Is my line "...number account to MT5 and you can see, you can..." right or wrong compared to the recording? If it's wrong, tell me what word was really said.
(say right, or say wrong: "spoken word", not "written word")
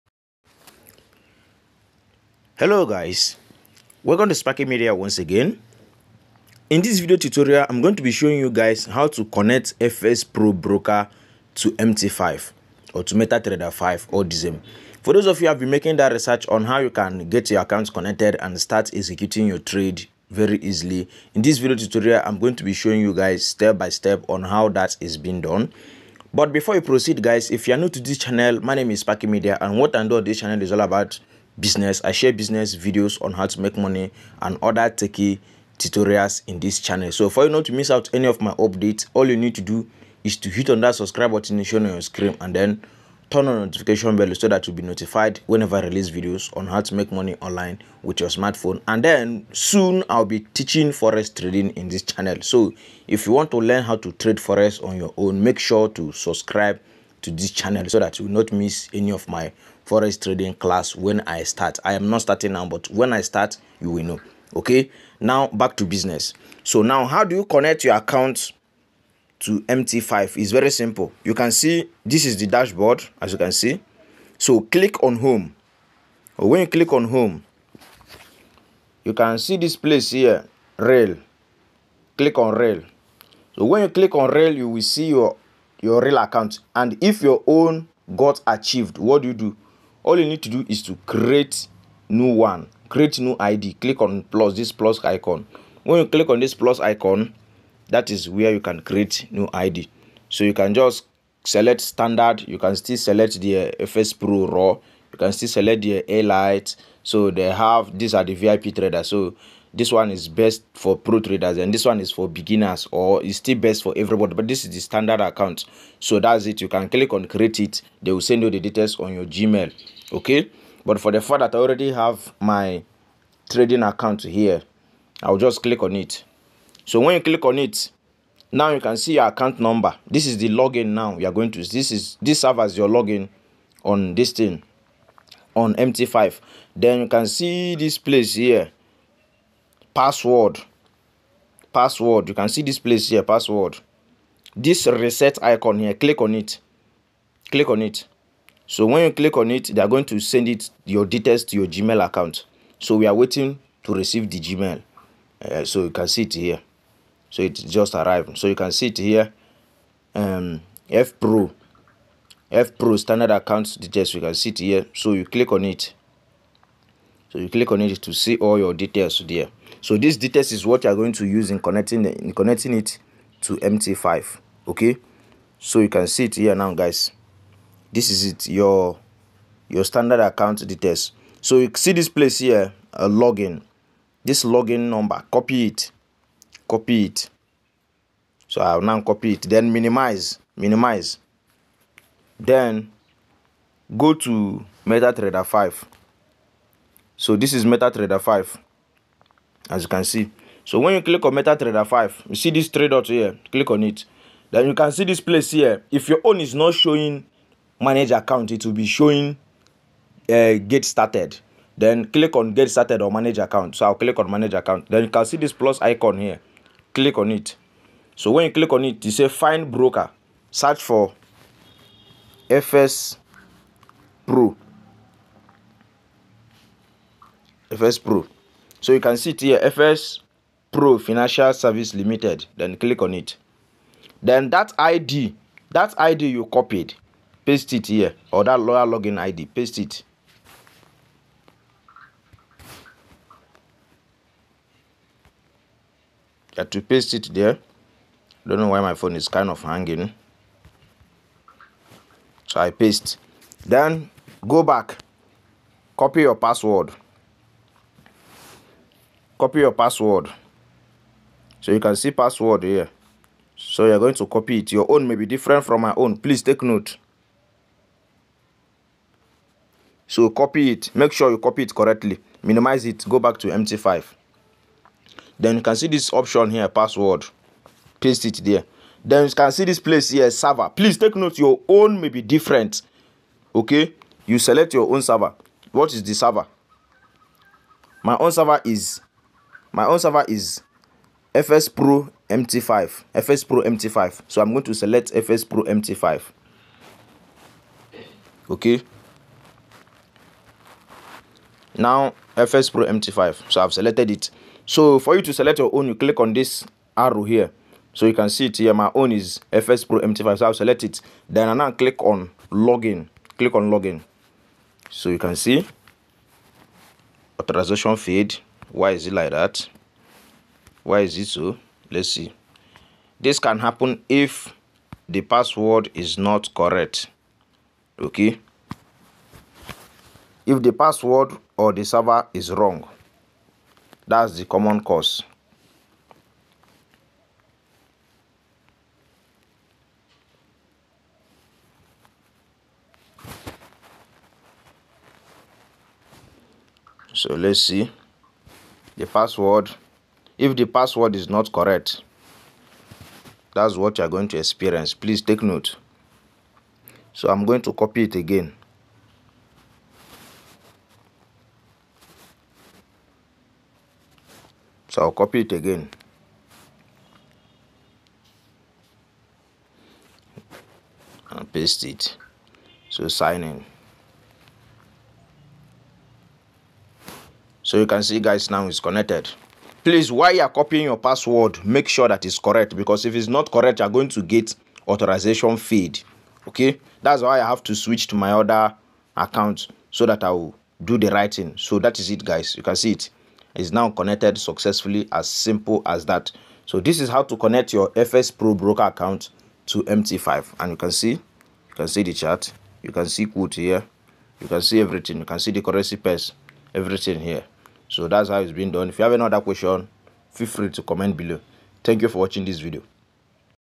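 wrong: "broker", not "number".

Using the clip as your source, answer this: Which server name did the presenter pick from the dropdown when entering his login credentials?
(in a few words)
FxPro MT5.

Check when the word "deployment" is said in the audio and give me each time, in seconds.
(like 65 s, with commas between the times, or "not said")
not said.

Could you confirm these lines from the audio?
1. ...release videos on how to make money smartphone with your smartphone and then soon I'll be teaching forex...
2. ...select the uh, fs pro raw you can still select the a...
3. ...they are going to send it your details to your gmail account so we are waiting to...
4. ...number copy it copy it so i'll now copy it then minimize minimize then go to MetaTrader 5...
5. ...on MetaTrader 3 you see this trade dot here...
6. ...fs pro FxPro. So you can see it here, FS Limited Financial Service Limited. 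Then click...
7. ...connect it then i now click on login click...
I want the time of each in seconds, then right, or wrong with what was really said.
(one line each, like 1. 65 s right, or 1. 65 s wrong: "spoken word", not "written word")
1. 45 s wrong: "online", not "smartphone"
2. 102 s right
3. 149 s right
4. 184 s right
5. 201 s wrong: "5", not "3"
6. 222 s wrong: "Pro", not "Limited"
7. 310 s wrong: "select", not "connect".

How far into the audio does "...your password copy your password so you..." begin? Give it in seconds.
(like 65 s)
256 s.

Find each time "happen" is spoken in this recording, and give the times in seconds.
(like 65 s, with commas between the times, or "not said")
323 s.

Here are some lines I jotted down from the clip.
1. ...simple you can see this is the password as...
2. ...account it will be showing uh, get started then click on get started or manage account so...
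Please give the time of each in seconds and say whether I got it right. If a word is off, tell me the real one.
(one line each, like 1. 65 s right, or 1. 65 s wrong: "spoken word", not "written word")
1. 70 s wrong: "dashboard", not "password"
2. 208 s right.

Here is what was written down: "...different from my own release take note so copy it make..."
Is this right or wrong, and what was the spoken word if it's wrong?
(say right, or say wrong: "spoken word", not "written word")
wrong: "please", not "release".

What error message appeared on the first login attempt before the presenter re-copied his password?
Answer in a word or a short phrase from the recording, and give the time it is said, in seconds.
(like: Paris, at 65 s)
authorization failed, at 317 s.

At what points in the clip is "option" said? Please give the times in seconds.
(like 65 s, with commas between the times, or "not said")
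276 s.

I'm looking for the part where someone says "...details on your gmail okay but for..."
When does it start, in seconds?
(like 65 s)
118 s.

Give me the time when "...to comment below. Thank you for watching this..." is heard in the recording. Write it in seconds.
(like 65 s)
410 s.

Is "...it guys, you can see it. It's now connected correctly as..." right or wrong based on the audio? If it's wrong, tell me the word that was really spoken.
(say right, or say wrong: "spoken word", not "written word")
wrong: "successfully", not "correctly".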